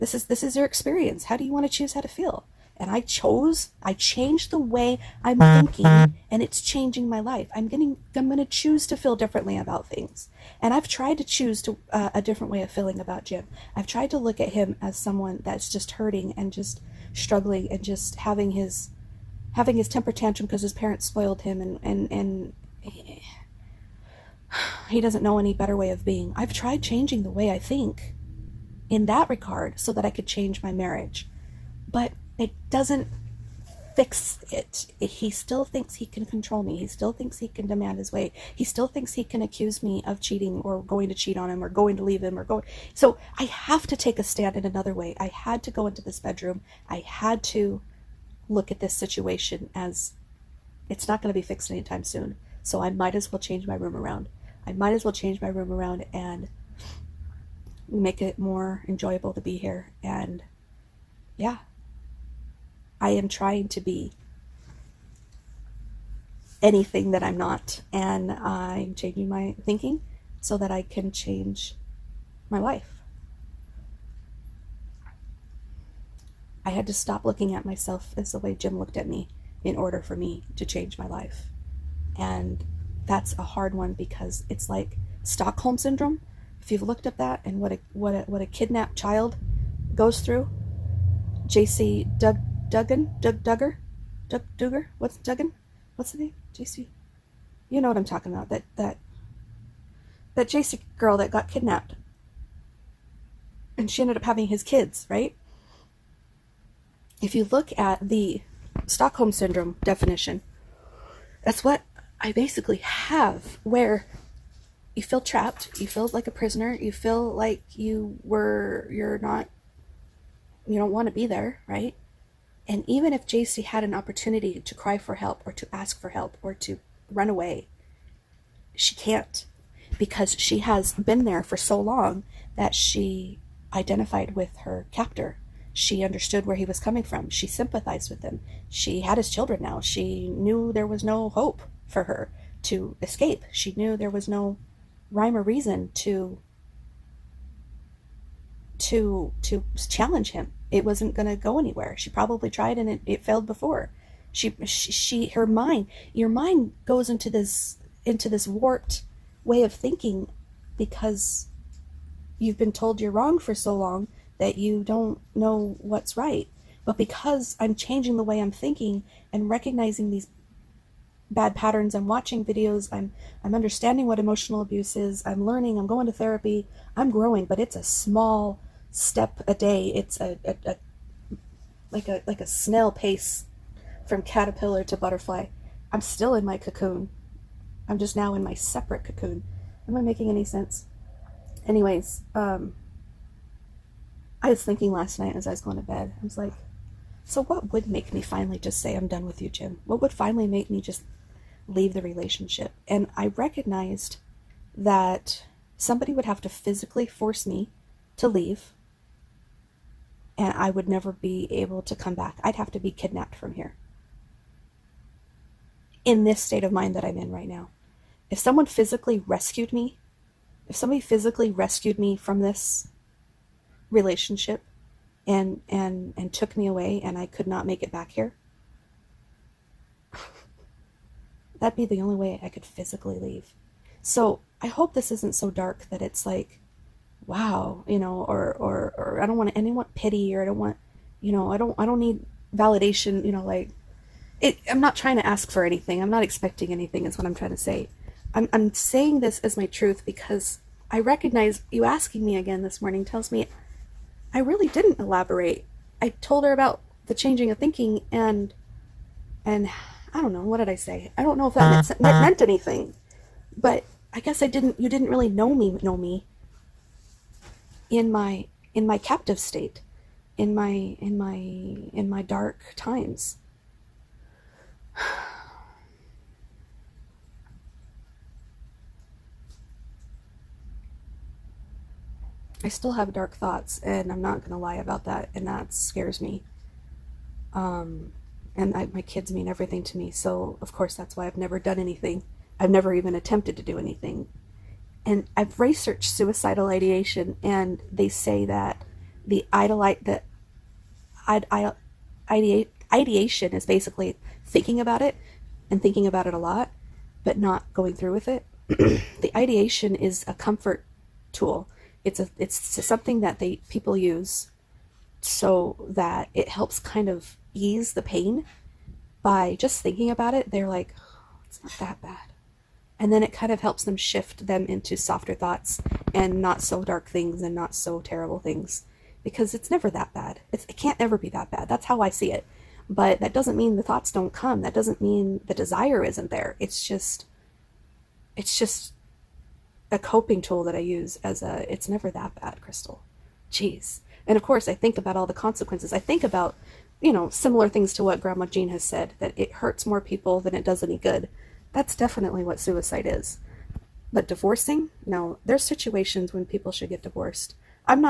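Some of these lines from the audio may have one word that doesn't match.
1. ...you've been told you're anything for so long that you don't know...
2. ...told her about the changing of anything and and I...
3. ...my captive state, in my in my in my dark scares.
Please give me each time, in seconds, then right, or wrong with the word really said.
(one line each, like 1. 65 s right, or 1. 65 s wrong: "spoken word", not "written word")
1. 162 s wrong: "wrong", not "anything"
2. 256 s wrong: "thinking", not "anything"
3. 268 s wrong: "times", not "scares".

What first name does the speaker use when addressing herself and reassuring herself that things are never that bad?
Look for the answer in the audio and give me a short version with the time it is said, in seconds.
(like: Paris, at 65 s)
Crystal, at 342 s.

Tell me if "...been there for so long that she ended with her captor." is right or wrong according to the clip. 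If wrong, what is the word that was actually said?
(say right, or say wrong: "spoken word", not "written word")
wrong: "identified", not "ended".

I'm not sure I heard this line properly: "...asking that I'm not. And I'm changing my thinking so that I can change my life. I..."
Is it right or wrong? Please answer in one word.
wrong.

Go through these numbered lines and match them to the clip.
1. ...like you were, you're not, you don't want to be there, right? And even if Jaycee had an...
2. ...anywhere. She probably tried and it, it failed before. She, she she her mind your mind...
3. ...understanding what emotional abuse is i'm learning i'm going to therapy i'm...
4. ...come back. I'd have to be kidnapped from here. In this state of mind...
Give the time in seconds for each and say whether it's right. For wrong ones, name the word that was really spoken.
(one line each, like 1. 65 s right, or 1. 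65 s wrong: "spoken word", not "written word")
1. 117 s right
2. 151 s right
3. 173 s right
4. 211 s right.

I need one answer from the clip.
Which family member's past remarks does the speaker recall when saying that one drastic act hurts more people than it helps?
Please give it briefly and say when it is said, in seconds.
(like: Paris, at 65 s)
Grandma Jean, at 348 s.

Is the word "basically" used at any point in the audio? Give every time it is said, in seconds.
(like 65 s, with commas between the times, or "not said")
112 s, 303 s.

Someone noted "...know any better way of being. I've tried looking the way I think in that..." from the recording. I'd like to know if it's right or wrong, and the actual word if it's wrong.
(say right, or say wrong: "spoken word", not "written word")
wrong: "changing", not "looking".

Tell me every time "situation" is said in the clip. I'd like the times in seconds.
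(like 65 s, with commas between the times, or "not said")
48 s, 355 s.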